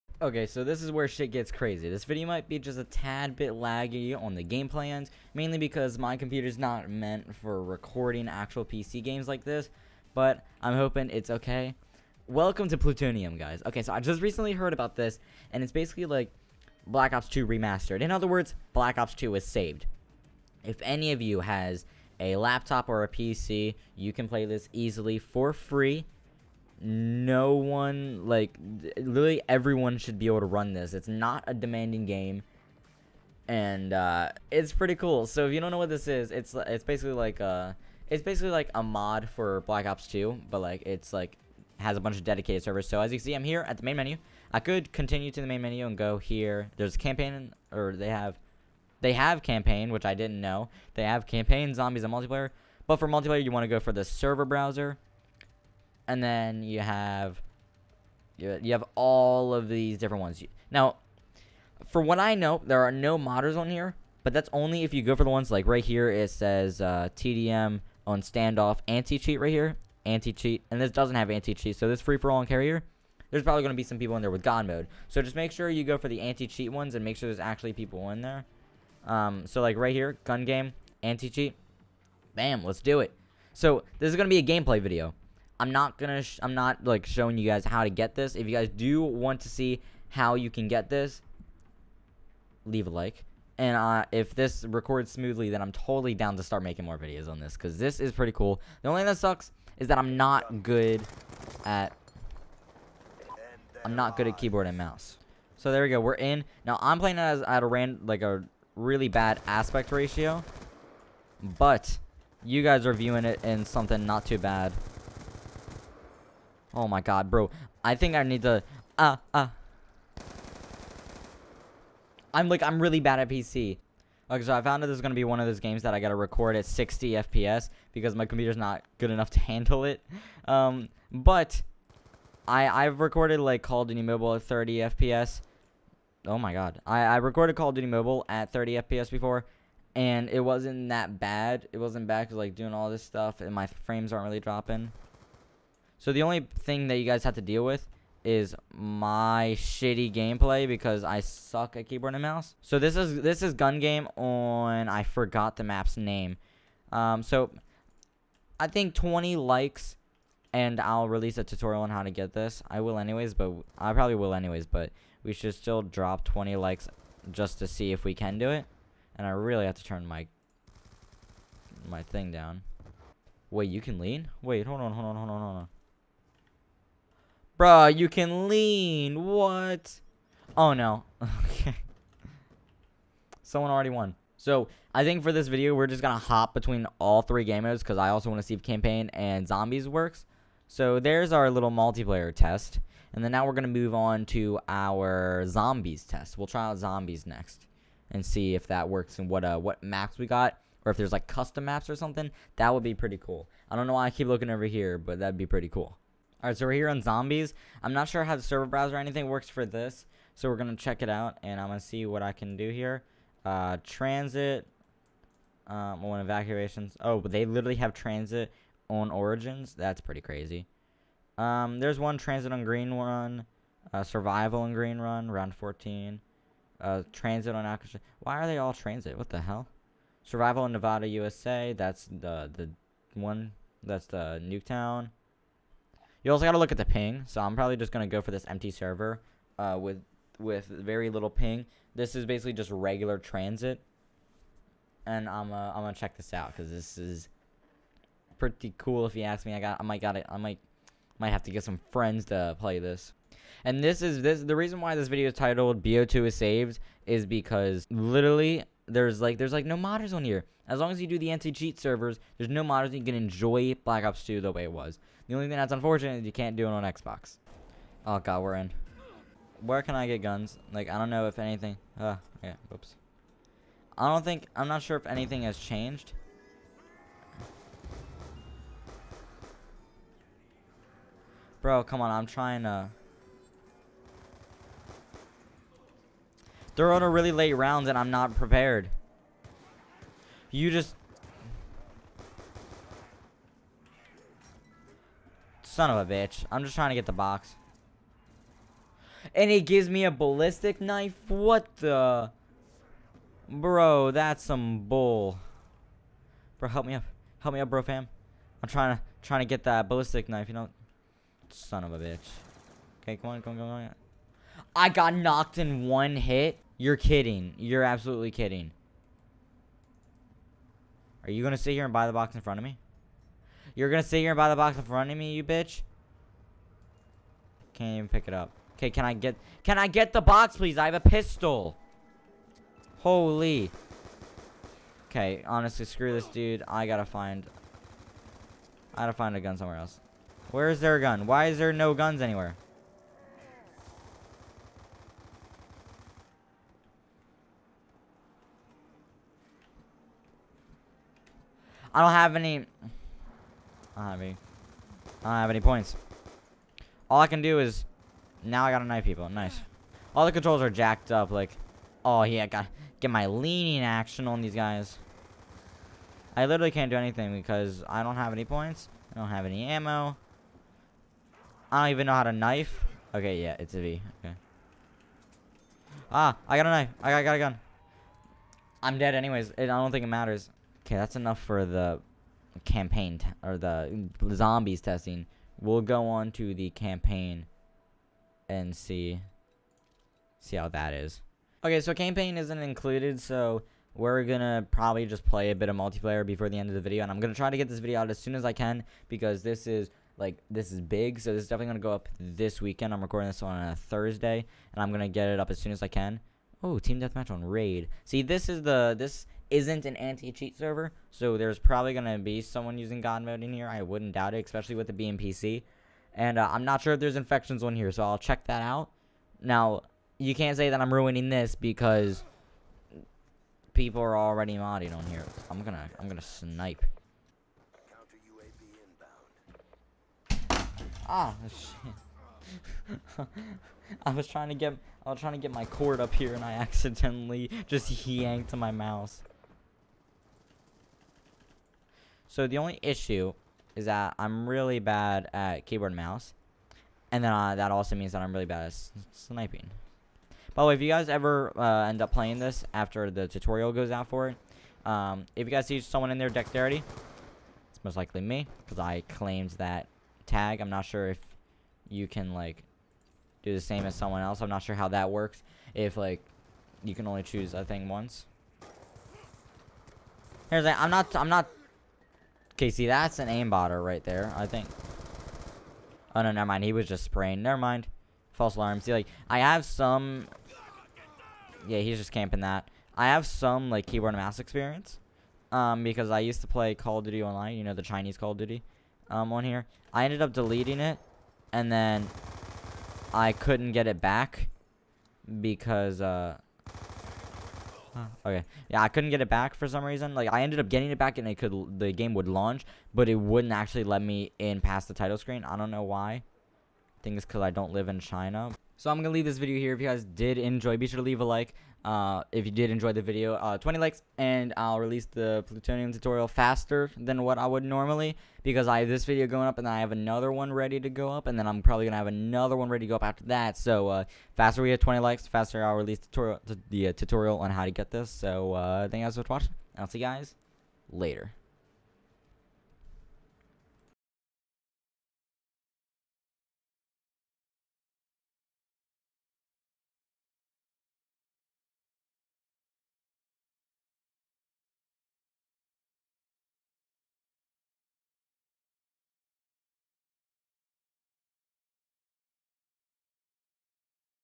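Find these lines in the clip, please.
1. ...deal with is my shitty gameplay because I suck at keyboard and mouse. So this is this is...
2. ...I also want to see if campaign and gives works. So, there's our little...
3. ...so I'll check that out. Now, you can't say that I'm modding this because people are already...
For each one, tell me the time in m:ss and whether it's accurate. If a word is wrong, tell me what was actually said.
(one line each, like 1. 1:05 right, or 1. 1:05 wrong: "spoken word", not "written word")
1. 2:27 right
2. 3:07 wrong: "zombies", not "gives"
3. 6:57 wrong: "ruining", not "modding".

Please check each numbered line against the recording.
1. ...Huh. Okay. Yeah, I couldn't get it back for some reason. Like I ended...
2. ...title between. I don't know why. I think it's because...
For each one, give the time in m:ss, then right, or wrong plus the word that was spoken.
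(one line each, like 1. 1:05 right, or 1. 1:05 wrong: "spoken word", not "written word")
1. 8:17 right
2. 8:24 wrong: "screen", not "between".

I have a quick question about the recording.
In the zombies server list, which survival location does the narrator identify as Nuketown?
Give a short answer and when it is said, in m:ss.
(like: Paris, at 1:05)
Nevada, USA, at 3:50.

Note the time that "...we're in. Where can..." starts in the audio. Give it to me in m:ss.
4:28.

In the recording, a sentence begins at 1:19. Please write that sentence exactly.
Um, so like right here, gun game, anti-cheat, bam, let's do it.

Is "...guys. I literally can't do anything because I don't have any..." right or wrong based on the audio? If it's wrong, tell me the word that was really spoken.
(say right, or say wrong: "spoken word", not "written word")
right.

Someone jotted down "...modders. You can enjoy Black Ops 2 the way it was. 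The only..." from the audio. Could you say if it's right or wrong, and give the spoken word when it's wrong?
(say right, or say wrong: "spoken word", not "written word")
right.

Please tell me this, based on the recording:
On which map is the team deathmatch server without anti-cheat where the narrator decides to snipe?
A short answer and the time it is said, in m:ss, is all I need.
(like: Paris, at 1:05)
Raid, at 6:47.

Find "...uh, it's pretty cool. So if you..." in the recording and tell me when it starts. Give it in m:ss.
0:33.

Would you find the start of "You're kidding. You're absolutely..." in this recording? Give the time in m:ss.
5:16.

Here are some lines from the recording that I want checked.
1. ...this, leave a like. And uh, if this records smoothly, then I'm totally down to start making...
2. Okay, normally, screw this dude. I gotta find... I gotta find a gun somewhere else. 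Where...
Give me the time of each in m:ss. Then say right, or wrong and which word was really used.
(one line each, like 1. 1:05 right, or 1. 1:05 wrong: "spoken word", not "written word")
1. 1:30 right
2. 5:35 wrong: "honestly", not "normally".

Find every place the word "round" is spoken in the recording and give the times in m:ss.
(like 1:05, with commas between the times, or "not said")
3:45, 4:47.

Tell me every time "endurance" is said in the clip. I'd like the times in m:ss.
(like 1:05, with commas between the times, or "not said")
not said.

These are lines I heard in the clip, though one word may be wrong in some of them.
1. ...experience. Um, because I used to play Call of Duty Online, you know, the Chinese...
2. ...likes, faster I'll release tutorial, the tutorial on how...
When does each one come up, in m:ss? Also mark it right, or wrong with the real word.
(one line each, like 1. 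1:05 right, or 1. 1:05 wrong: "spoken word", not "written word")
1. 8:04 right
2. 8:44 right.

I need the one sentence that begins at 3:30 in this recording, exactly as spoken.
So we're going to check it out, and I'm going to see what I can do here.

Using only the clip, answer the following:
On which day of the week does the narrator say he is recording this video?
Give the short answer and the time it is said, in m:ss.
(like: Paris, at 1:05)
Thursday, at 6:43.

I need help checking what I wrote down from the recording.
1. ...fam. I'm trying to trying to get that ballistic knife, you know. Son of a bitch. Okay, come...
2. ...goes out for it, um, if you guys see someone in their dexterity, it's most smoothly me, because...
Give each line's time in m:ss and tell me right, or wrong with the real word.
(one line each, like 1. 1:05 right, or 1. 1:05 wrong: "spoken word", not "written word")
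1. 5:07 right
2. 7:33 wrong: "likely", not "smoothly".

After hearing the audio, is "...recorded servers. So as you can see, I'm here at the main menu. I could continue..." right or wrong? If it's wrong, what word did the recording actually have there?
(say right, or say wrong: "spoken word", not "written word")
wrong: "dedicated", not "recorded".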